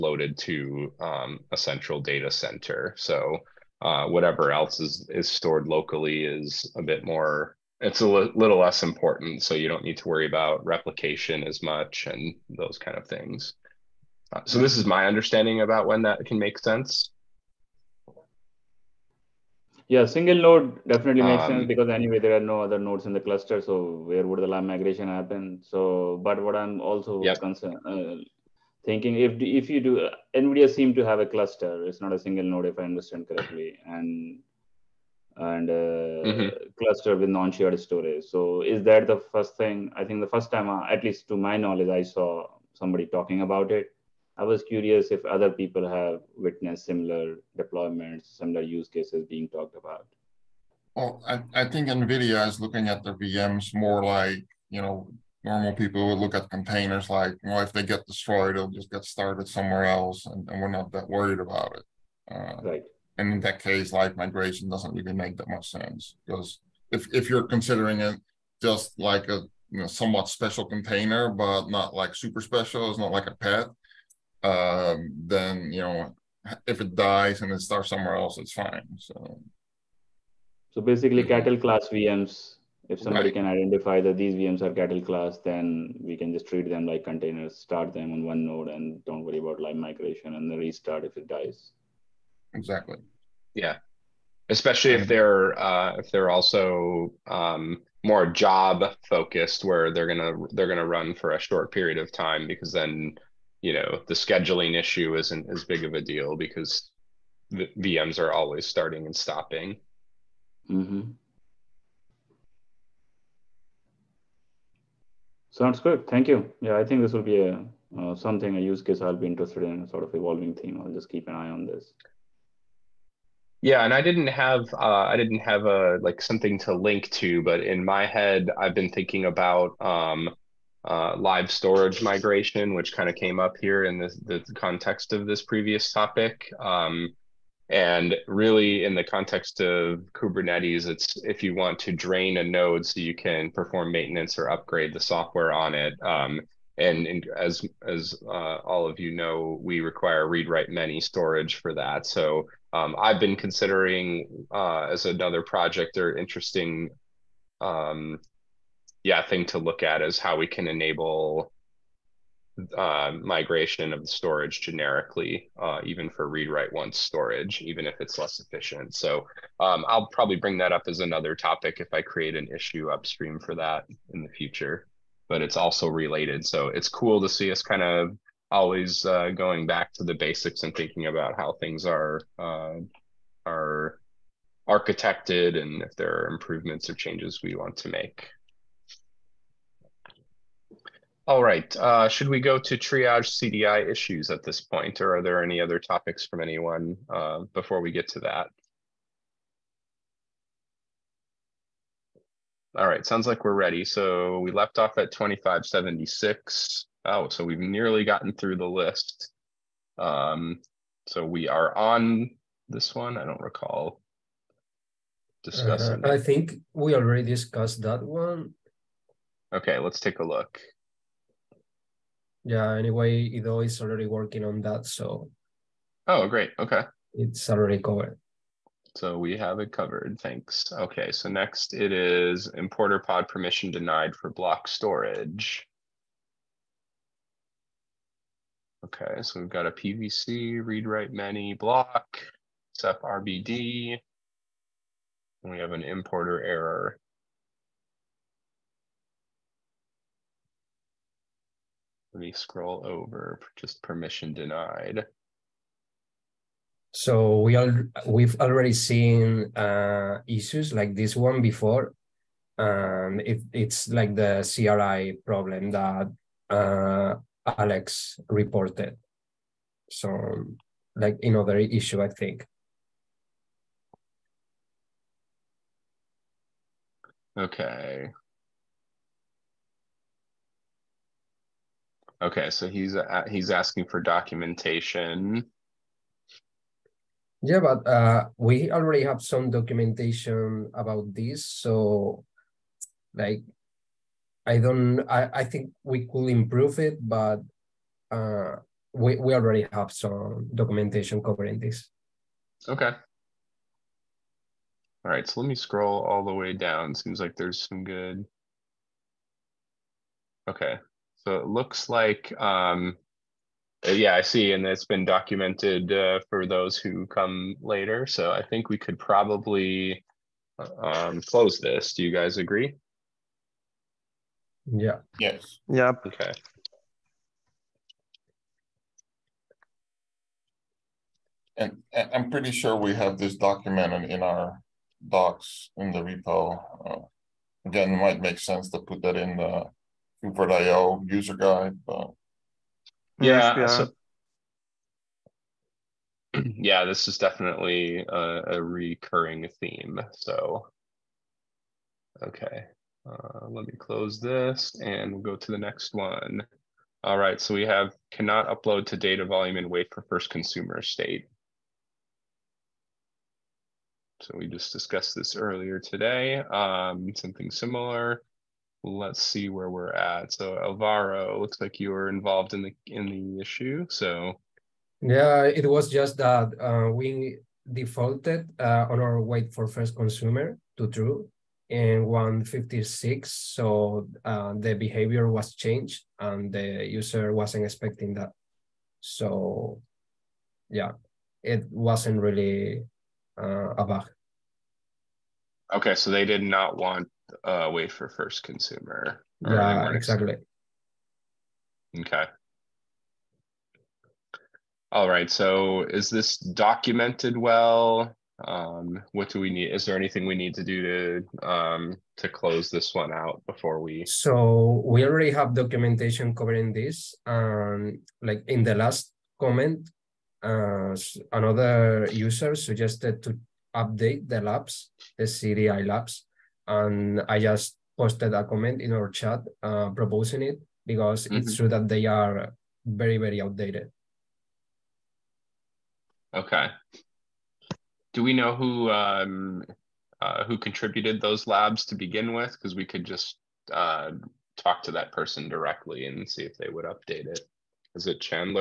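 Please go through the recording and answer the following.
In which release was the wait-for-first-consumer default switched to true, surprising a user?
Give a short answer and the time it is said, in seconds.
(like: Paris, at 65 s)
156, at 382 s.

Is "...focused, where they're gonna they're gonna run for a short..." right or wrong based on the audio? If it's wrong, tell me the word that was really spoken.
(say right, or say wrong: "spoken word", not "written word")
right.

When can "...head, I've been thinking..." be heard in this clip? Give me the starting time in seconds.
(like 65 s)
128 s.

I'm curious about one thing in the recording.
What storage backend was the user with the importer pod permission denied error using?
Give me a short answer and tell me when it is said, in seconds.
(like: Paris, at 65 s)
Ceph RBD, at 242 s.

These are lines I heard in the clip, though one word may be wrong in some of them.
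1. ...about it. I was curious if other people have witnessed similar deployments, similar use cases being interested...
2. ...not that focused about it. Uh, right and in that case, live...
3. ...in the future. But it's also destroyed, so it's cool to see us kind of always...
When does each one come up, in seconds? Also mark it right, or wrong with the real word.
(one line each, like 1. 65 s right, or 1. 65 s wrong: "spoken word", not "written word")
1. 43 s wrong: "talked", not "interested"
2. 60 s wrong: "worried", not "focused"
3. 174 s wrong: "related", not "destroyed".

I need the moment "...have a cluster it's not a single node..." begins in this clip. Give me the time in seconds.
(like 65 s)
31 s.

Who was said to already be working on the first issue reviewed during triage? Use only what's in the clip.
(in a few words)
Ido.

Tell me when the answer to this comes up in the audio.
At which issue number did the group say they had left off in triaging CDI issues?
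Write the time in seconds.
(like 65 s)
205 s.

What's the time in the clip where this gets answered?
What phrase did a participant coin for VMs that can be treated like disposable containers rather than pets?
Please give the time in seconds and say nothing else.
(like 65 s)
81 s.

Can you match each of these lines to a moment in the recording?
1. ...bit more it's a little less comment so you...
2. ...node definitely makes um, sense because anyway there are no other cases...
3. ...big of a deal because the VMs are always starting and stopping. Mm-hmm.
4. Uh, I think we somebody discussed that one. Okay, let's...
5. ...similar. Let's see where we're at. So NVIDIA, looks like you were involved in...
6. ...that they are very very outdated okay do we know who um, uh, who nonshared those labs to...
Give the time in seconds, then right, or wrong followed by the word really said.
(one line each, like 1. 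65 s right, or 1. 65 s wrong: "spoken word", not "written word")
1. 6 s wrong: "important", not "comment"
2. 20 s wrong: "nodes", not "cases"
3. 105 s right
4. 216 s wrong: "already", not "somebody"
5. 367 s wrong: "Alvaro", not "NVIDIA"
6. 431 s wrong: "contributed", not "nonshared".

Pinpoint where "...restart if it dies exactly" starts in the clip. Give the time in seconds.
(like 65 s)
90 s.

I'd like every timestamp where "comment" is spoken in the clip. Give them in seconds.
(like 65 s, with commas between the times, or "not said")
419 s, 428 s.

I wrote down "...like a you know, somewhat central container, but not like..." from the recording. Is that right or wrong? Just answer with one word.
wrong.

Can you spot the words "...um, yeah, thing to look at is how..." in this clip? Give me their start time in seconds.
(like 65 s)
157 s.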